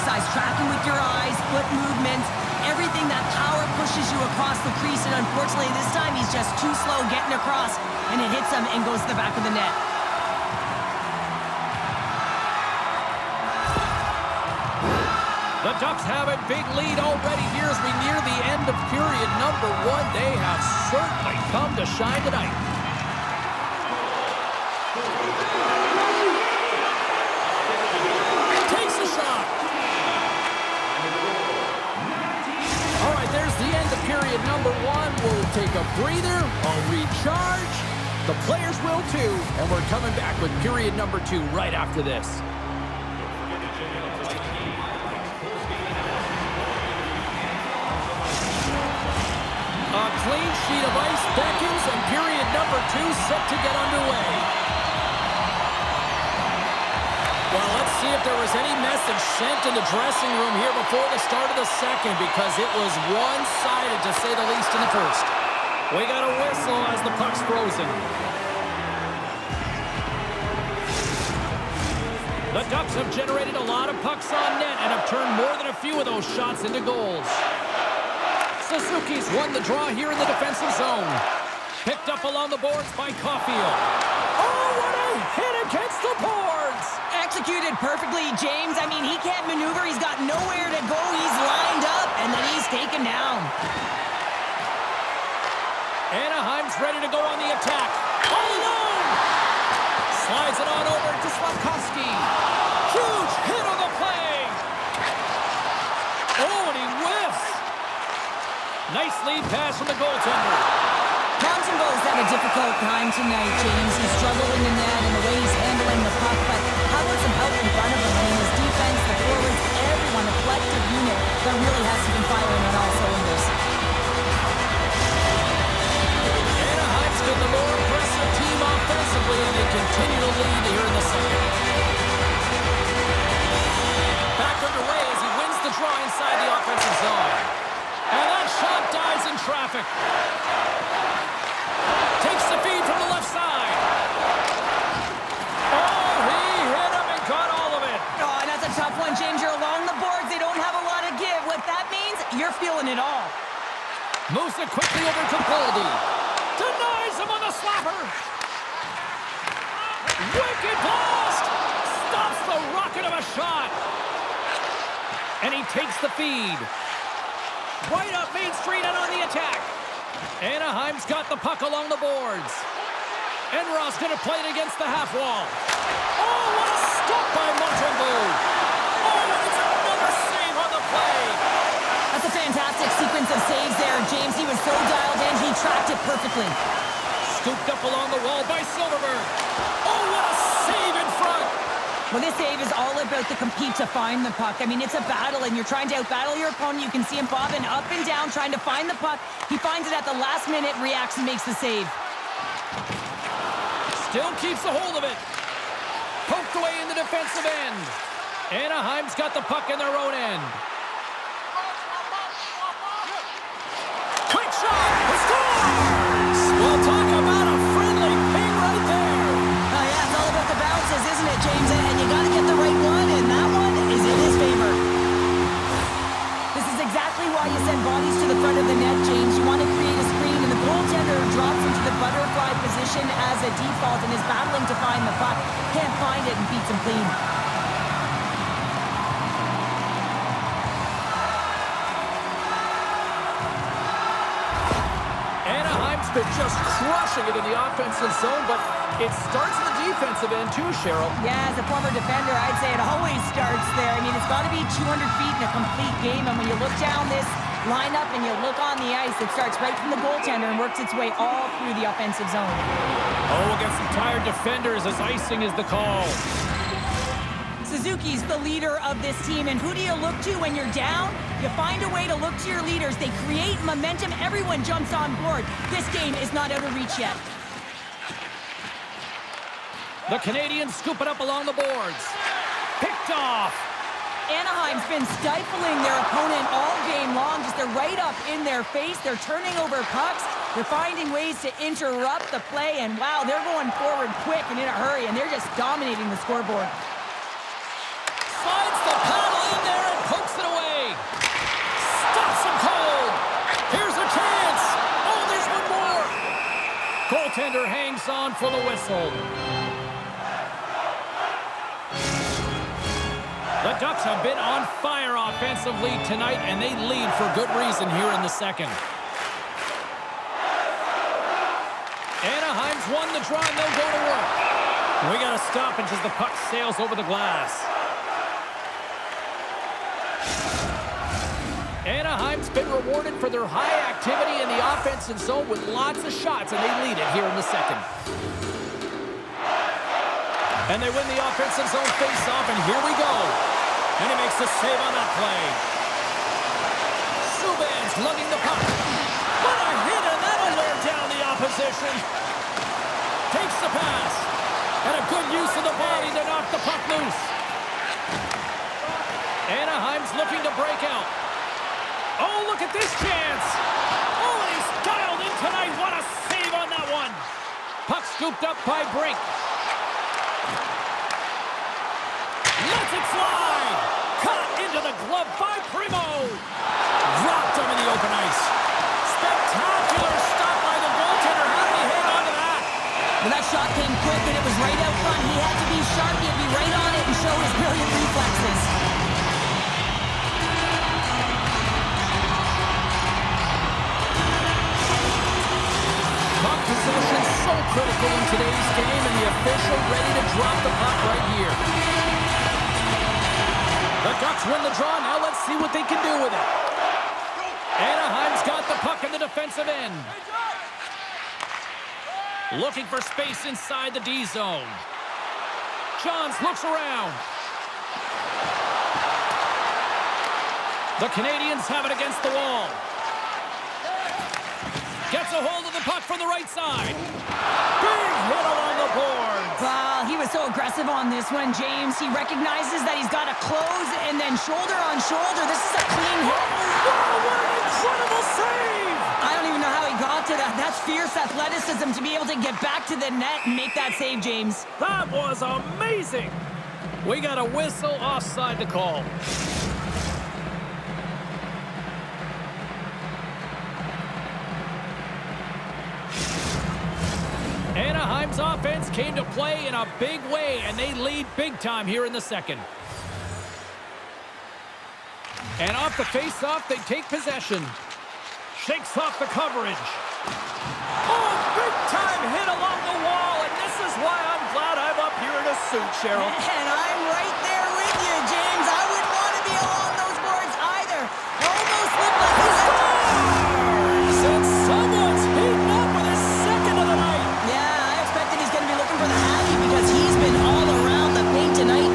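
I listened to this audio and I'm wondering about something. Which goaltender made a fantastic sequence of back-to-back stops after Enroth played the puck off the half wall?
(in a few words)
Montembeault.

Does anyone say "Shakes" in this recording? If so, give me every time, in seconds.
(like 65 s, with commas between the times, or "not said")
468 s.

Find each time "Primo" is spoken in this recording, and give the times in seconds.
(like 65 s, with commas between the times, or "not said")
375 s.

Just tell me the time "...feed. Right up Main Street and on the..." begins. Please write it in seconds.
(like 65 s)
166 s.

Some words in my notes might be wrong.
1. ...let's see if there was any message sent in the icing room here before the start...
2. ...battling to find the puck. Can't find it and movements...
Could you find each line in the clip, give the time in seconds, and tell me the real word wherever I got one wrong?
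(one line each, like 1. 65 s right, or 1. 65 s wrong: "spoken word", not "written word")
1. 57 s wrong: "dressing", not "icing"
2. 234 s wrong: "beats", not "movements".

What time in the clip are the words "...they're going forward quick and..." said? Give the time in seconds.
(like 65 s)
293 s.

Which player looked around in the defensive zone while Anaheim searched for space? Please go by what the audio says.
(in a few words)
Johns.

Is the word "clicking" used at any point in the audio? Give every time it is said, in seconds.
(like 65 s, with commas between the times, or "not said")
not said.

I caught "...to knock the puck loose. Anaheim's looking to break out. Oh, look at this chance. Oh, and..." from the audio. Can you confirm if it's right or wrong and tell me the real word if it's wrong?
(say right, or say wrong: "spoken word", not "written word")
right.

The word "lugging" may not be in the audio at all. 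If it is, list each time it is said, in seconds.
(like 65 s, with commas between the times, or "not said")
348 s.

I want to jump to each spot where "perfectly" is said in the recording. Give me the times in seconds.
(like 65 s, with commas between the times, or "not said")
87 s, 186 s.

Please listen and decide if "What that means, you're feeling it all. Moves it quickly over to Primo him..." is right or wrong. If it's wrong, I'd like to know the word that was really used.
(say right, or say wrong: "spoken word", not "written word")
wrong: "Goldie", not "Primo".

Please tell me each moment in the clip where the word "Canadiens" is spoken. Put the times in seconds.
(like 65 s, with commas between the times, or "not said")
280 s, 421 s.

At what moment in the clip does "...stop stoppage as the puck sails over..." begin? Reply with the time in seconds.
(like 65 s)
325 s.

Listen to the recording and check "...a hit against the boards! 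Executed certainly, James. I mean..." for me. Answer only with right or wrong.
wrong.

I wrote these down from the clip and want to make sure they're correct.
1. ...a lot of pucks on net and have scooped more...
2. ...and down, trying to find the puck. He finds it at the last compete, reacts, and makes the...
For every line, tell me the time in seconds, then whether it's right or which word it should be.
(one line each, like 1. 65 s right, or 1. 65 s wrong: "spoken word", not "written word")
1. 73 s wrong: "turned", not "scooped"
2. 197 s wrong: "minute", not "compete".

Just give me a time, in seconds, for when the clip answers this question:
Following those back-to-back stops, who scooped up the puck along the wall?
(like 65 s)
188 s.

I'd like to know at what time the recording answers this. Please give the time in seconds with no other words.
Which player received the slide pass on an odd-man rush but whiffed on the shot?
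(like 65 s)
101 s.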